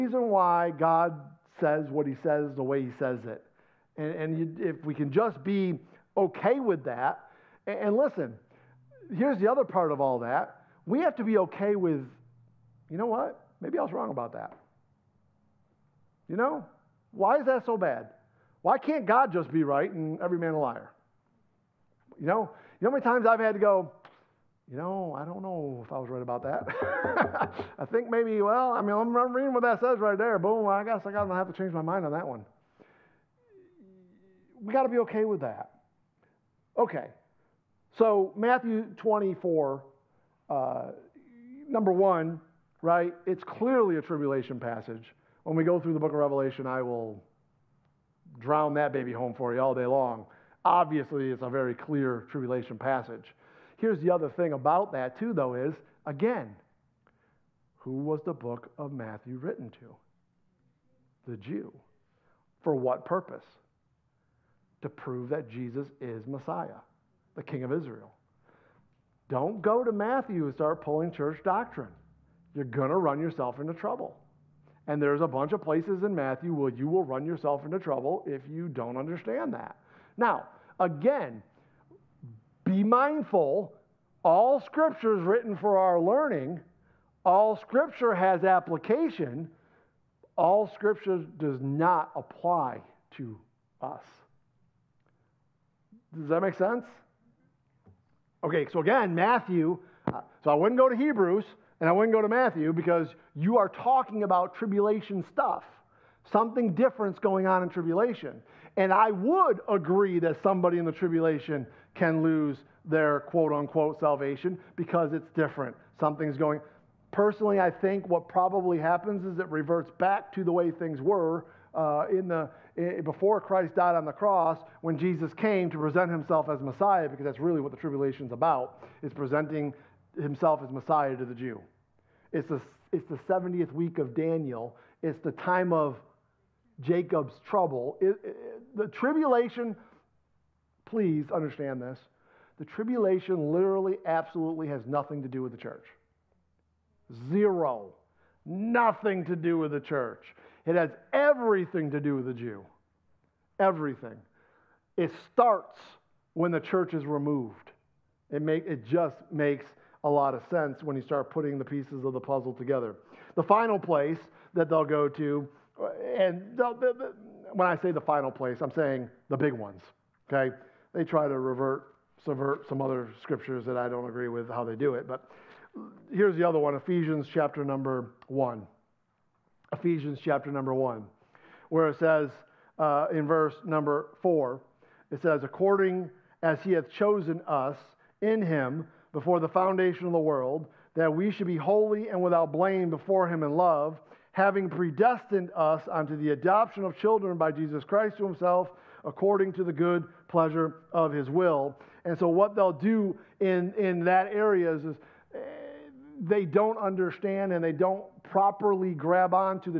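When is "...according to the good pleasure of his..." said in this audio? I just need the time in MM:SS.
03:19.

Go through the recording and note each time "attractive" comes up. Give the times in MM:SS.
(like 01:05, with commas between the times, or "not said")
not said.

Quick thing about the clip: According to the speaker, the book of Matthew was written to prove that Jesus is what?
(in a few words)
Messiah, the King of Israel.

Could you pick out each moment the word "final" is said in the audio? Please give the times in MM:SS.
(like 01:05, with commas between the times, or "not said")
02:43, 02:48.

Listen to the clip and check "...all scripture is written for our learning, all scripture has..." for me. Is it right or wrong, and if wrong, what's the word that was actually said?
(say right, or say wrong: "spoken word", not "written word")
right.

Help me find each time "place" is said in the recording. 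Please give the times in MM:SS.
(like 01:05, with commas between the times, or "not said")
01:15, 02:43, 02:48.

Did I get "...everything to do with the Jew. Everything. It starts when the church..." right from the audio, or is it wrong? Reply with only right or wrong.
right.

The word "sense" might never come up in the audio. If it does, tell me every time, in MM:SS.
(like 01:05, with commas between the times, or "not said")
01:36, 02:40.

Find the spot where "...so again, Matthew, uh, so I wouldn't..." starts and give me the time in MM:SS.
01:38.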